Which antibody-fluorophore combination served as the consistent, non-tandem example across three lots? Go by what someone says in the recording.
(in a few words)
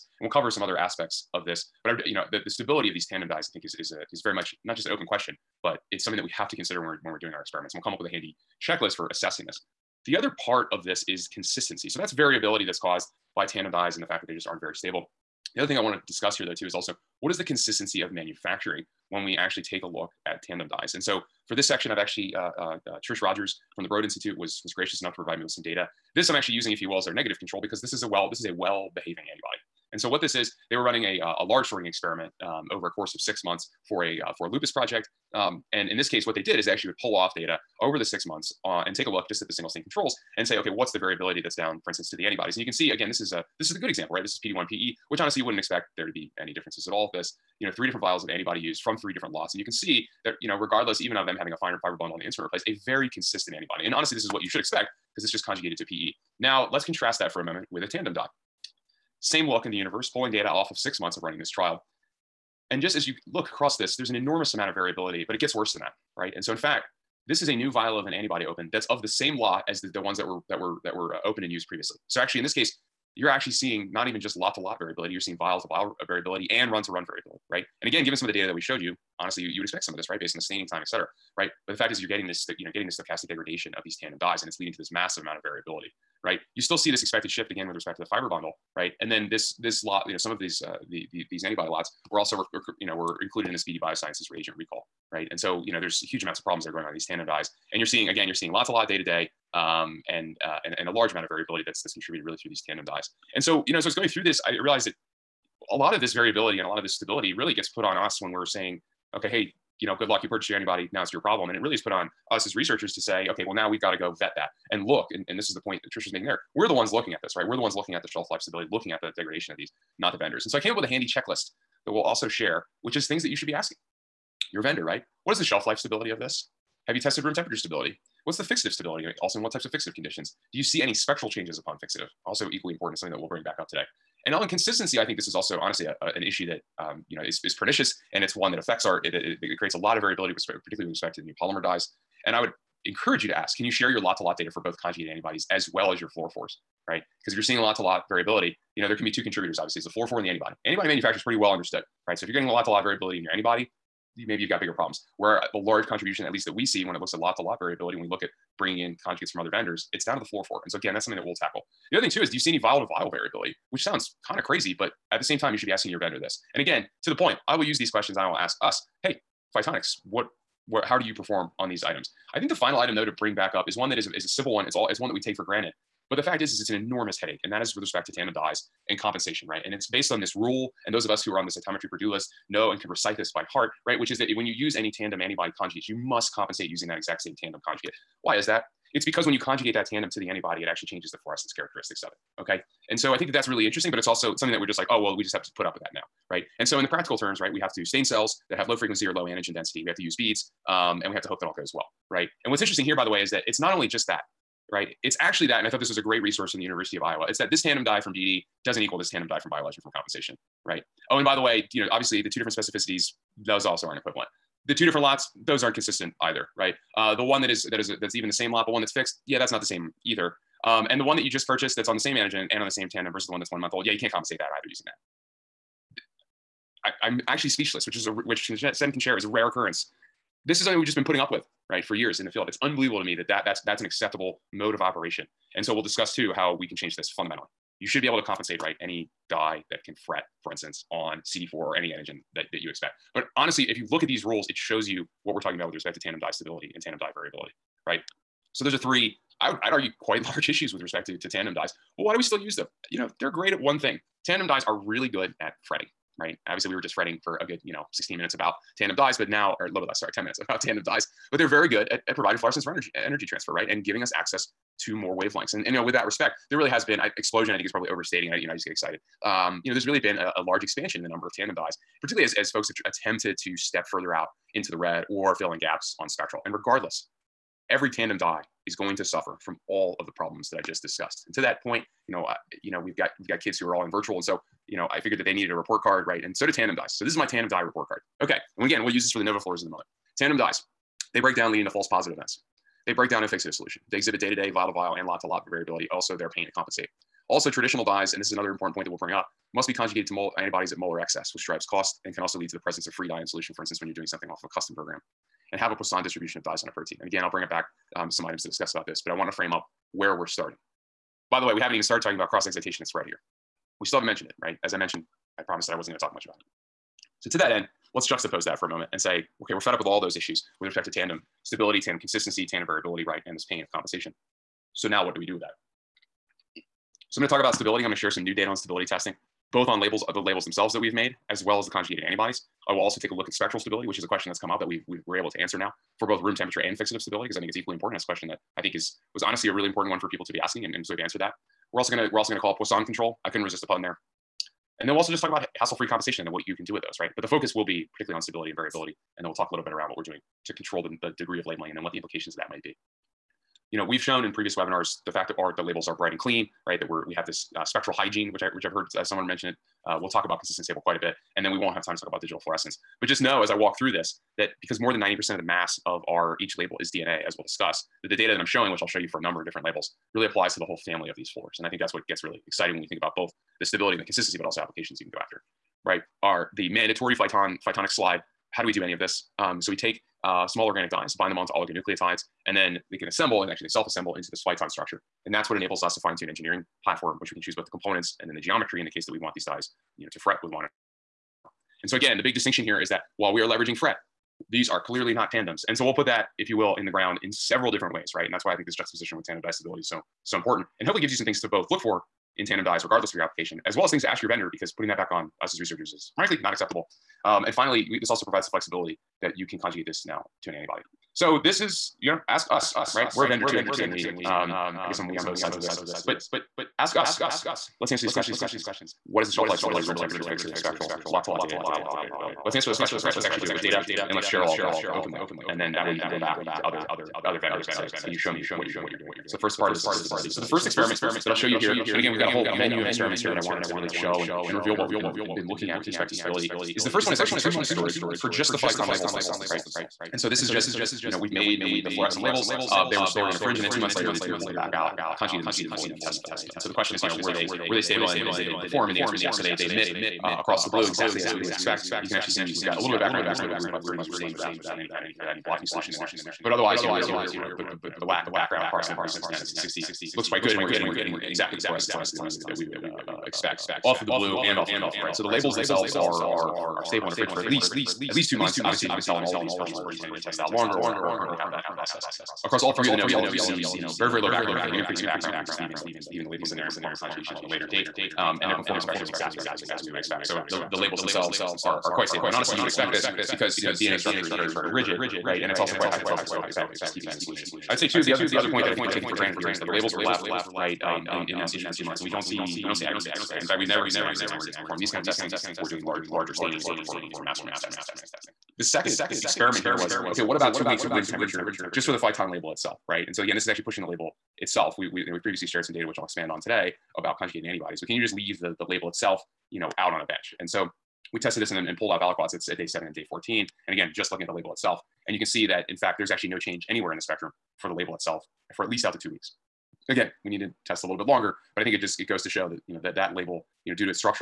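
PD1PE.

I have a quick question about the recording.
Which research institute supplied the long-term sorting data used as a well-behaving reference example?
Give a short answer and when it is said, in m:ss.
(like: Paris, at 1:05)
Broad Institute, at 0:23.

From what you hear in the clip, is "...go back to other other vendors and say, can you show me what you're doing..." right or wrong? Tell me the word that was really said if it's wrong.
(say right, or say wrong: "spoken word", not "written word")
right.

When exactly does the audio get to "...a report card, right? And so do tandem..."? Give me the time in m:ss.
4:45.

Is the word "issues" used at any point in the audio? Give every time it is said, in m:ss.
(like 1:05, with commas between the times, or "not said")
2:16, 4:10, 5:20.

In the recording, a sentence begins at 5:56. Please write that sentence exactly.
That we're we have this uh, spectral hygiene, which I which I've heard uh, someone mention it.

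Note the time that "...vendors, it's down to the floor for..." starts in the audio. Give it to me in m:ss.
2:39.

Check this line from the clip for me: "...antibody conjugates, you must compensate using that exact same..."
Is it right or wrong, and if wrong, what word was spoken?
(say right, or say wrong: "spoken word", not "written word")
right.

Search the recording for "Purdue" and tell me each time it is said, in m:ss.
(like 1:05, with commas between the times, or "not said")
3:01.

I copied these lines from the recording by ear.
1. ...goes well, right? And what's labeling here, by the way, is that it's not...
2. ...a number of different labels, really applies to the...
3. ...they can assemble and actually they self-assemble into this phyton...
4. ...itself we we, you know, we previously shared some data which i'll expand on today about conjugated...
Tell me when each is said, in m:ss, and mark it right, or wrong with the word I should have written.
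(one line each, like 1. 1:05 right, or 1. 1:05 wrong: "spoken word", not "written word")
1. 3:21 wrong: "interesting", not "labeling"
2. 6:09 right
3. 6:22 right
4. 8:24 right.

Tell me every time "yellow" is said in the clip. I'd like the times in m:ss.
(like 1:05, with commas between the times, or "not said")
7:44, 7:53.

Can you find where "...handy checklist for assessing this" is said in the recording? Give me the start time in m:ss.
0:08.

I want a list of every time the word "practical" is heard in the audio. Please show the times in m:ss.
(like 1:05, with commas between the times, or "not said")
3:16.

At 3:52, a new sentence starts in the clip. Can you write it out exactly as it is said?
It's unbelievable to me that, that that's that's an acceptable mode of operation.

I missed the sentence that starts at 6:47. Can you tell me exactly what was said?
Um, and finally, we, this also provides the flexibility that you can conjugate this now to an antibody.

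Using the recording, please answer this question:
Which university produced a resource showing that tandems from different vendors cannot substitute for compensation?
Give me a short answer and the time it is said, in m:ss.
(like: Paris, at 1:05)
University of Iowa, at 3:26.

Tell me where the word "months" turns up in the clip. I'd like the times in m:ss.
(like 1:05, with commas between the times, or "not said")
0:33, 0:38, 1:00, 3:43, 7:17, 7:23, 7:48, 8:11.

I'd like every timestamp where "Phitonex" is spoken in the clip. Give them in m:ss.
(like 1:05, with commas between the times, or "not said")
2:49, 6:17.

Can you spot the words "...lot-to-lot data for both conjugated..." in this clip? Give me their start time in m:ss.
2:23.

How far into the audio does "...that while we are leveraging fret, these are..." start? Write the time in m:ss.
6:32.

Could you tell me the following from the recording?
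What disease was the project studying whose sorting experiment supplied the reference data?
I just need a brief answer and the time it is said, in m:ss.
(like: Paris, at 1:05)
lupus, at 0:34.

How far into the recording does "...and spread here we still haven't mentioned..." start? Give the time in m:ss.
5:12.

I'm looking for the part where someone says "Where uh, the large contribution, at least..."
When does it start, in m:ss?
2:35.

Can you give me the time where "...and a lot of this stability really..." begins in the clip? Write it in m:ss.
1:46.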